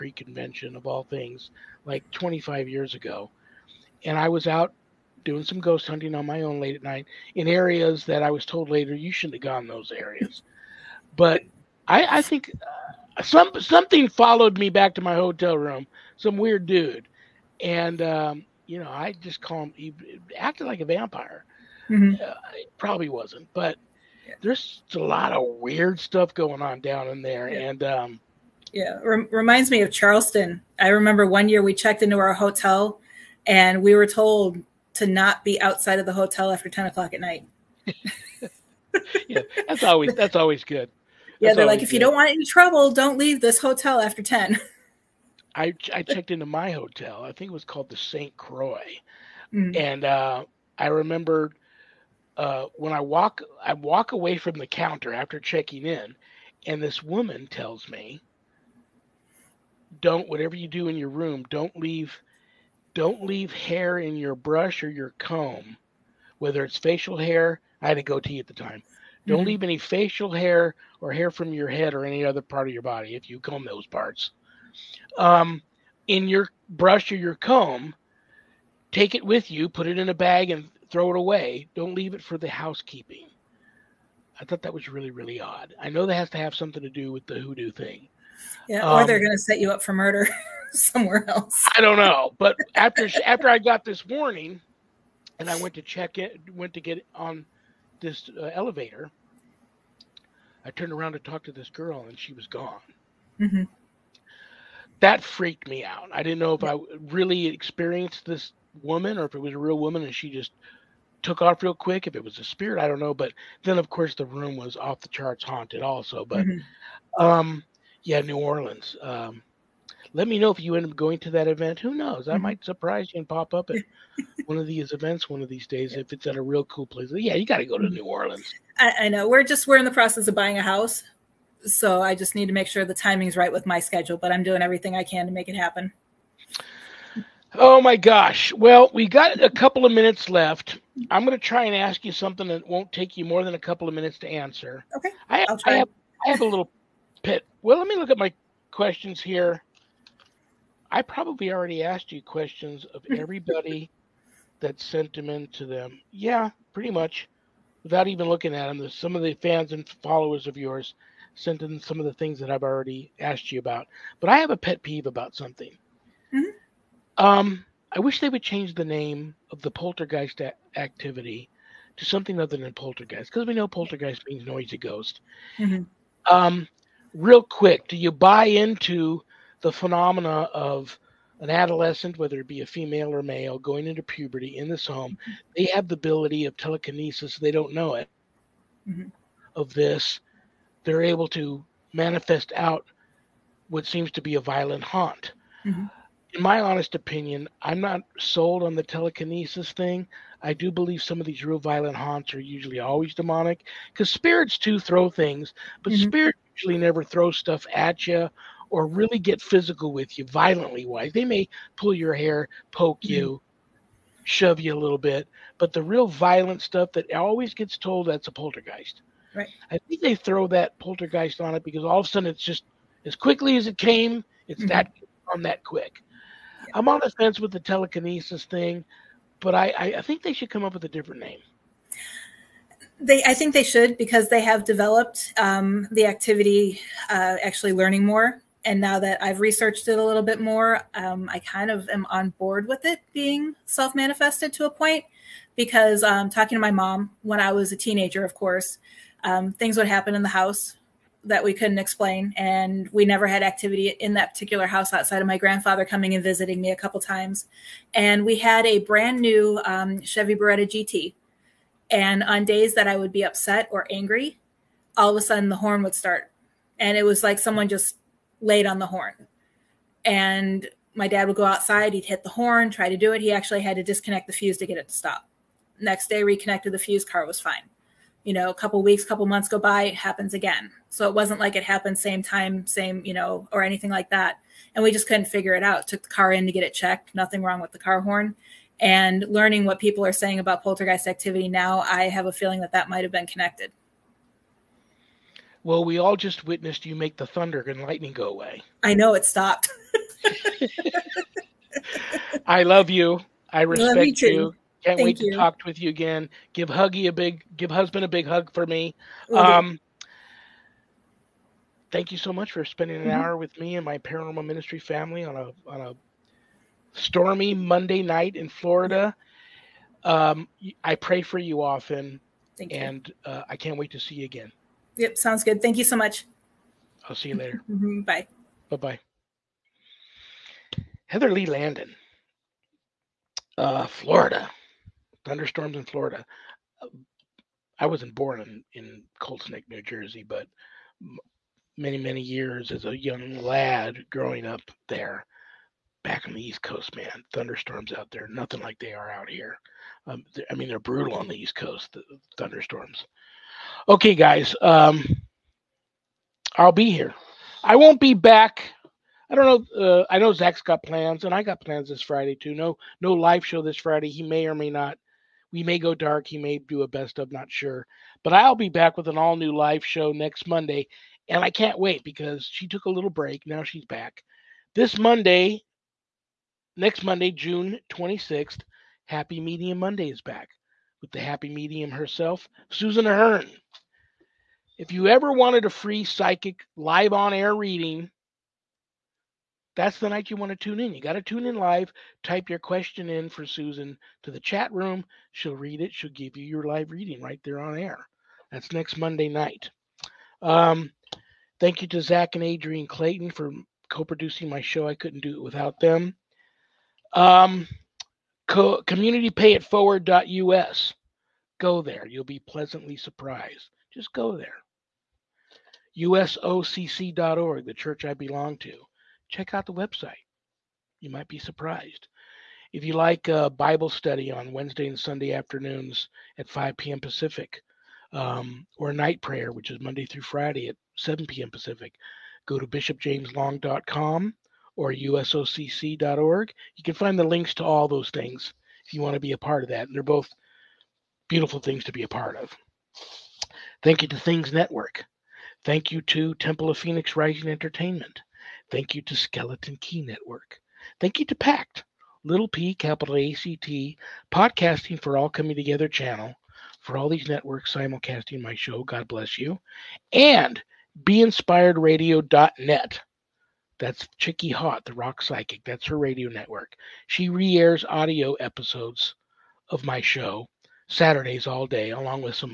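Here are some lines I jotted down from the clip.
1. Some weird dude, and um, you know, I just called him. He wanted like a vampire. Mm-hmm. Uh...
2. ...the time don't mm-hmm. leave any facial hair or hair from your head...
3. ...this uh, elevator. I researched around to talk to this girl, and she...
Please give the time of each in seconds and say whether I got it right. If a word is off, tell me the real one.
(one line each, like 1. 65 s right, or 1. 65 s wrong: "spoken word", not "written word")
1. 16 s wrong: "acted", not "wanted"
2. 68 s right
3. 98 s wrong: "turned", not "researched".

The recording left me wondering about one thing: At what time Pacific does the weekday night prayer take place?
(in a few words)
7 p.m.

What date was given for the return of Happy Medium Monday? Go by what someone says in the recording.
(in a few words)
June 26th.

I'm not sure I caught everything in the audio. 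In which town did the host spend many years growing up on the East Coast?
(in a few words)
Colts Neck, New Jersey.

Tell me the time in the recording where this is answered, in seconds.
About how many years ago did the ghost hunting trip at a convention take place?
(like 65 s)
2 s.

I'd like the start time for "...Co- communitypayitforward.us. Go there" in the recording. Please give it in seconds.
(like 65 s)
408 s.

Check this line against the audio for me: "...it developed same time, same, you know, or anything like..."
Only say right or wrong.
wrong.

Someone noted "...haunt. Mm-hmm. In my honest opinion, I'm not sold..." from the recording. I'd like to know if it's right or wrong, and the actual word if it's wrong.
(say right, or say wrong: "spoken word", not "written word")
right.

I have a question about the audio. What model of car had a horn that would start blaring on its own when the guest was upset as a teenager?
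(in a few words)
Chevy Beretta GT.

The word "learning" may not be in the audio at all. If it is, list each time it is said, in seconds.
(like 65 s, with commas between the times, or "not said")
237 s, 289 s.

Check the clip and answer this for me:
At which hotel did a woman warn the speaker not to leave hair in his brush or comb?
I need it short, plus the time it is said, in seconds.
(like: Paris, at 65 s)
Saint Croix, at 47 s.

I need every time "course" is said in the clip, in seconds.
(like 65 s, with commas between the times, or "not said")
113 s, 248 s.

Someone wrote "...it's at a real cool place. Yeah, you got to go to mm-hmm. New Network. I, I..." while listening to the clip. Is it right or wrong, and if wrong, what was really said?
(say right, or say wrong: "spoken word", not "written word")
wrong: "Orleans", not "Network".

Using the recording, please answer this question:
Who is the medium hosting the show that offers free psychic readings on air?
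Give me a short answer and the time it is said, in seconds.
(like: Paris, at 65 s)
Susan Ahern, at 382 s.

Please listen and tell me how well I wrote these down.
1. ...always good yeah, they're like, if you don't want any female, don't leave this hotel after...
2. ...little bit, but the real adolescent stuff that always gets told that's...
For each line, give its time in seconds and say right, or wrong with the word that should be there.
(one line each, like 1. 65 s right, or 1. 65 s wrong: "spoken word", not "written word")
1. 40 s wrong: "trouble", not "female"
2. 214 s wrong: "violent", not "adolescent".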